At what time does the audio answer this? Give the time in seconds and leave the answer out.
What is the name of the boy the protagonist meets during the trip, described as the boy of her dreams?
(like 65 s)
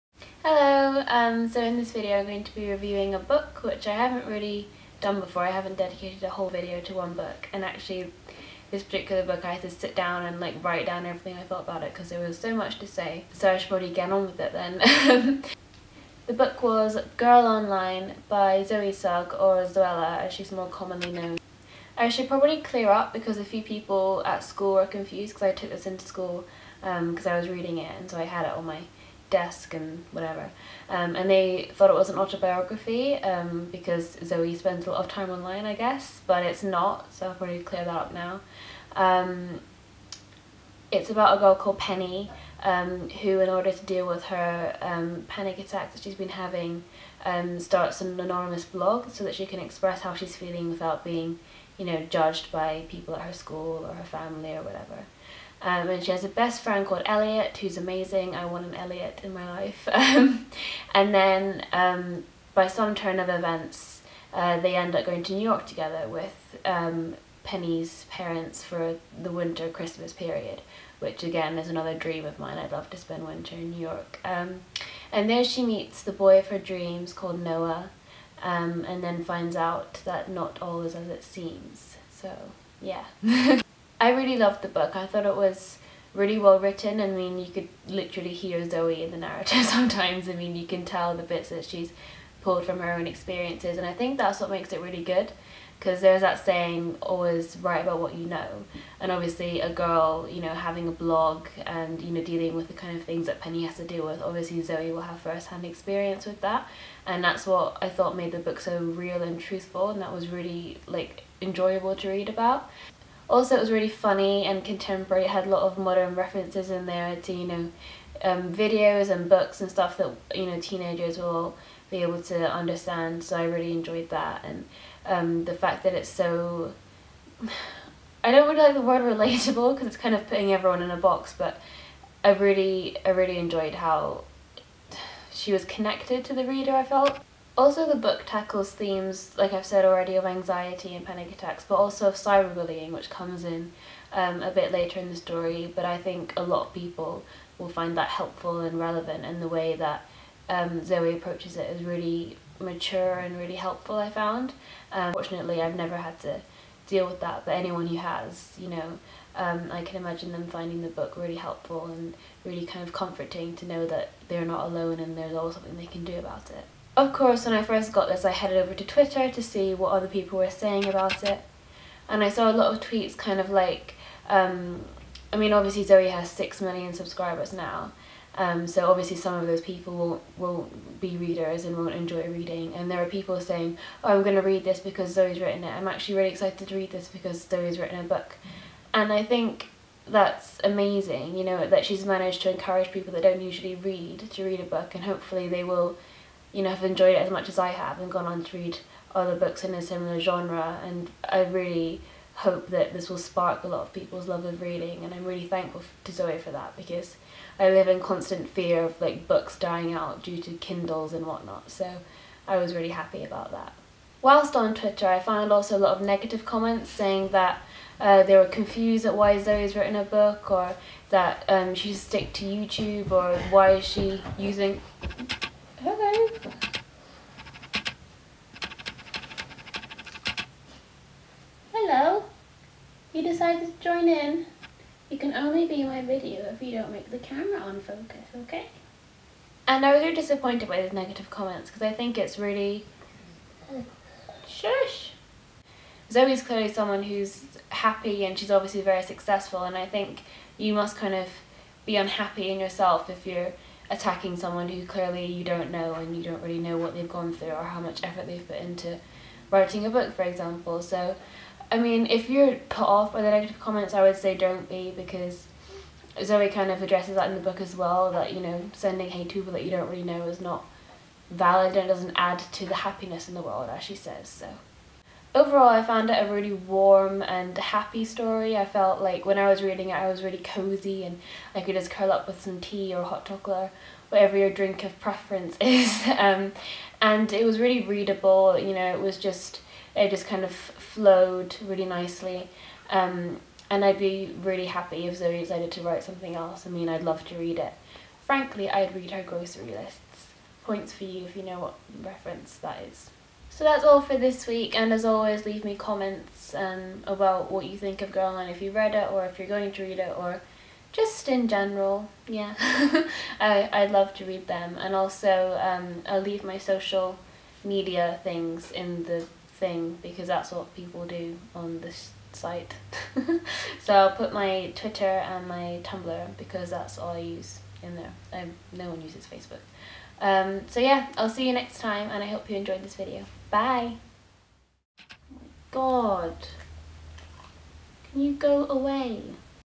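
77 s.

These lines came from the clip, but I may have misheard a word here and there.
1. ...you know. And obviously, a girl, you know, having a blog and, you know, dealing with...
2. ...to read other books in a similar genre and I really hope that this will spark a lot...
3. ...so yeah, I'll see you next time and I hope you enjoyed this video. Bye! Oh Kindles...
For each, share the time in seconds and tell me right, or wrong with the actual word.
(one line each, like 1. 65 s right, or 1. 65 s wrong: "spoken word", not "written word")
1. 98 s right
2. 198 s right
3. 330 s wrong: "God", not "Kindles".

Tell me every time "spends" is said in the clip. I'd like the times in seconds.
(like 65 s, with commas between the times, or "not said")
34 s, 72 s.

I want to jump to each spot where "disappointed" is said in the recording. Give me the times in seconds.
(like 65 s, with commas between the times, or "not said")
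240 s.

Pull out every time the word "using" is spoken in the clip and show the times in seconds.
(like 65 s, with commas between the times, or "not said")
224 s.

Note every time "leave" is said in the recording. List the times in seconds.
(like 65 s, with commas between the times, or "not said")
305 s, 316 s.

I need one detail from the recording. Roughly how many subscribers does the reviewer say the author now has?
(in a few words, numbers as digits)
6 million.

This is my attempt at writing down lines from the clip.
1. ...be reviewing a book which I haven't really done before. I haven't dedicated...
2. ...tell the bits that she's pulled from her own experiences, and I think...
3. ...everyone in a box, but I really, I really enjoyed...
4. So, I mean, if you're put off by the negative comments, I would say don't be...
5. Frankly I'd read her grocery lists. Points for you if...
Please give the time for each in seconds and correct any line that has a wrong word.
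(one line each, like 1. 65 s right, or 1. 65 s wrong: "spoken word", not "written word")
1. 2 s right
2. 90 s right
3. 130 s right
4. 260 s right
5. 298 s right.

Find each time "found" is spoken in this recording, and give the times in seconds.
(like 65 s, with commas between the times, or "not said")
154 s, 215 s, 275 s.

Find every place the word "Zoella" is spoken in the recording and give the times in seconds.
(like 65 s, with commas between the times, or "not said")
19 s.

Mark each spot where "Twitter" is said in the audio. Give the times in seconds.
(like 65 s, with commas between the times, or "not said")
168 s, 214 s, 324 s.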